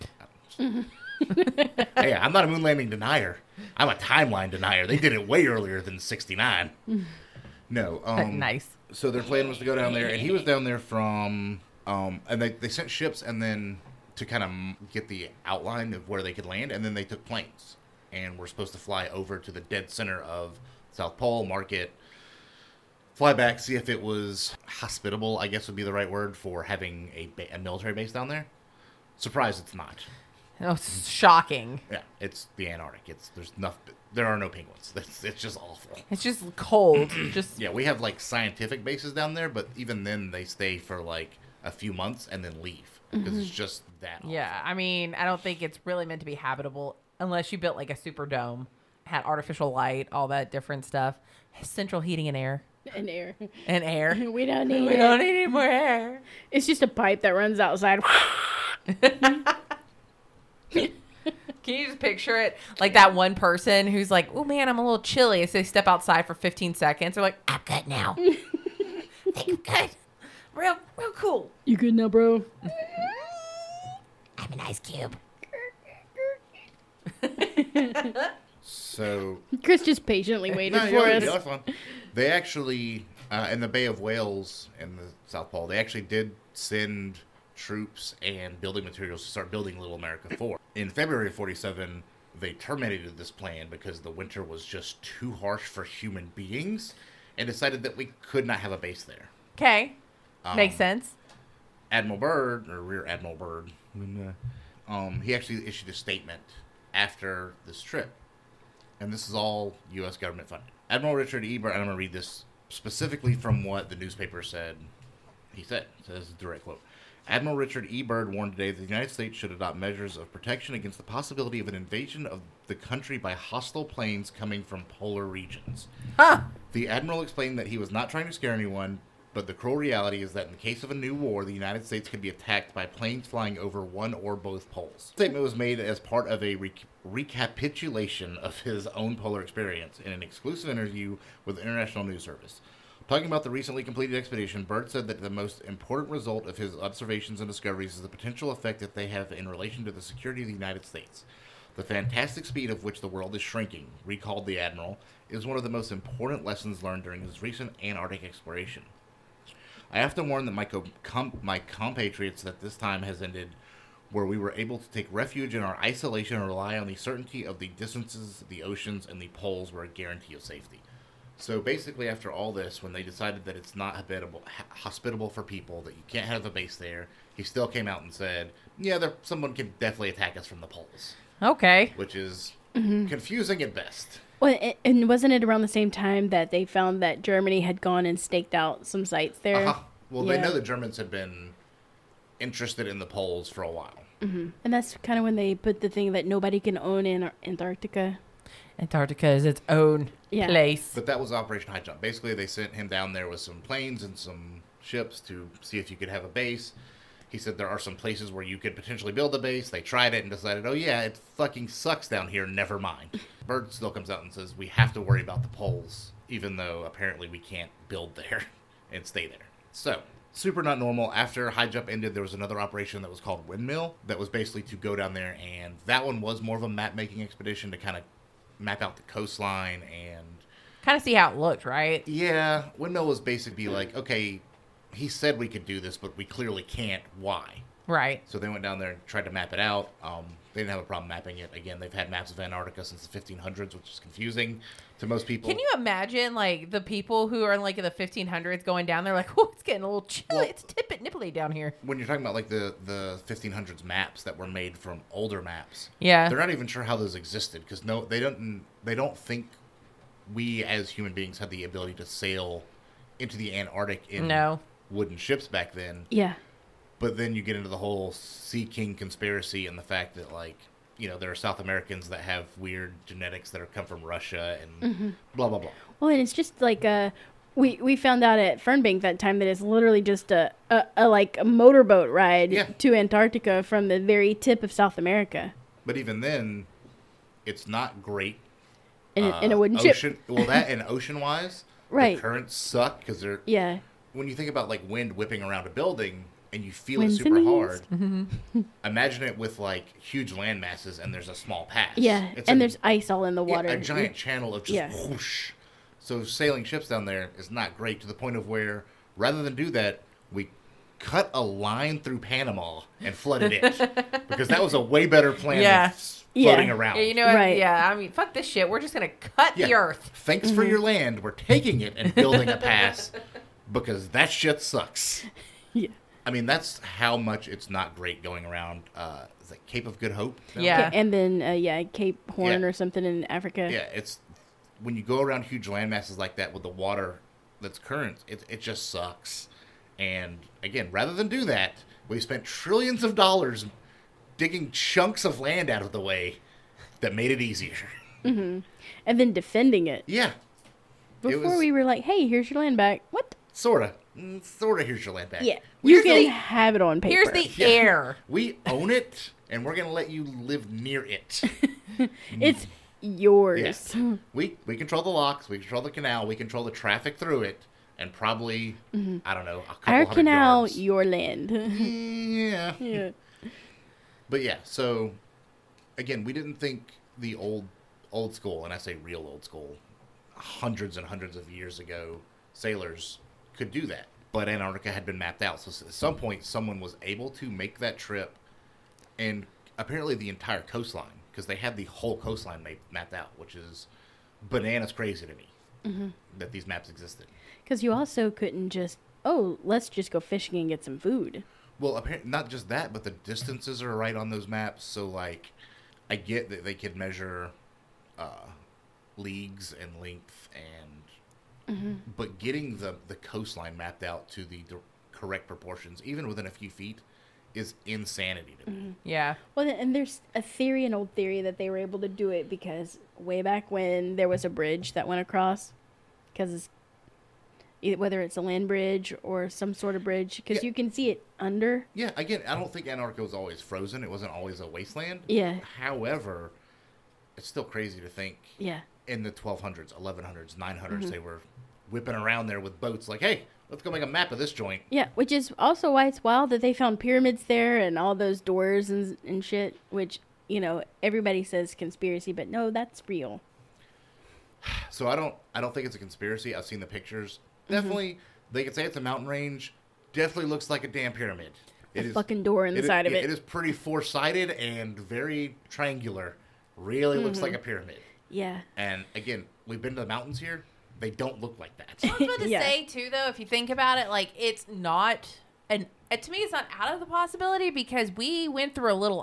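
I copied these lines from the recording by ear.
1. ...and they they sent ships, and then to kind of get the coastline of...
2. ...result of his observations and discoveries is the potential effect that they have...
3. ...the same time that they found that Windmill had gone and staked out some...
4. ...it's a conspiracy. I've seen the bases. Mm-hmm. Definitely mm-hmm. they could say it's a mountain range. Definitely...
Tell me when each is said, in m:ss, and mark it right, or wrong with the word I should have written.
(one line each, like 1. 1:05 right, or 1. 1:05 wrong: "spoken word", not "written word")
1. 0:12 wrong: "outline", not "coastline"
2. 2:26 right
3. 3:05 wrong: "Germany", not "Windmill"
4. 7:35 wrong: "pictures", not "bases".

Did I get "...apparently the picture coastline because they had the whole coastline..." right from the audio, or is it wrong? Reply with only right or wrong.
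wrong.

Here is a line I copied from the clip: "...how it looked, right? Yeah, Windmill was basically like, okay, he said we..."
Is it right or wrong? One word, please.
right.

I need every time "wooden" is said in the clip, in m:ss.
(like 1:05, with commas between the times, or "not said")
4:24, 4:49.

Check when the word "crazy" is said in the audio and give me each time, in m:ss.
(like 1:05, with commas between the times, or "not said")
6:34, 7:17.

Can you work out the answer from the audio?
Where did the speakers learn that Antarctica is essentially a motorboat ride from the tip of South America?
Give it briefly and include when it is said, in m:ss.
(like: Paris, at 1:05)
Fernbank, at 4:38.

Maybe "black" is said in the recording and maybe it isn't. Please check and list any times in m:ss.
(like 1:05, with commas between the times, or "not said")
not said.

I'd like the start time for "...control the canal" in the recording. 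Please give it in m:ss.
6:05.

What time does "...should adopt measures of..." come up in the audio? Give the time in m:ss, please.
1:59.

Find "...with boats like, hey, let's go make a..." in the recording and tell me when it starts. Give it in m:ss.
7:22.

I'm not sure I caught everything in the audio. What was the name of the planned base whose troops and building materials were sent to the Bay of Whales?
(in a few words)
Little America 4.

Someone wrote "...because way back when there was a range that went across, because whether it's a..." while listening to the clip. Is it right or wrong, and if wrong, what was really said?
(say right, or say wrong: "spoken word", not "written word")
wrong: "bridge", not "range".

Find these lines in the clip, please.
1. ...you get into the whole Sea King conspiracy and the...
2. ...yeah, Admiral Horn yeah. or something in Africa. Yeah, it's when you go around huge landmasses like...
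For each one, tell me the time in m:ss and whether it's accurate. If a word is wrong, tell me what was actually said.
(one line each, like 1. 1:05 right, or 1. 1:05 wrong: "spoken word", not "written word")
1. 4:27 right
2. 5:31 wrong: "Cape", not "Admiral".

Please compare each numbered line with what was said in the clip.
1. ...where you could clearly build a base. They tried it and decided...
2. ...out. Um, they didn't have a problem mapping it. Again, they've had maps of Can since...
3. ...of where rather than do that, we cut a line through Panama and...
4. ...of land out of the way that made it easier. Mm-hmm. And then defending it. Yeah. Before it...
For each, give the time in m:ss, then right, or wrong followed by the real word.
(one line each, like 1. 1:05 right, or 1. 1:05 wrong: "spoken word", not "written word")
1. 3:28 wrong: "potentially", not "clearly"
2. 3:59 wrong: "Antarctica", not "Can"
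3. 5:08 right
4. 5:45 right.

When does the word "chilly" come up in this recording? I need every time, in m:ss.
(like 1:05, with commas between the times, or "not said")
1:05, 4:10.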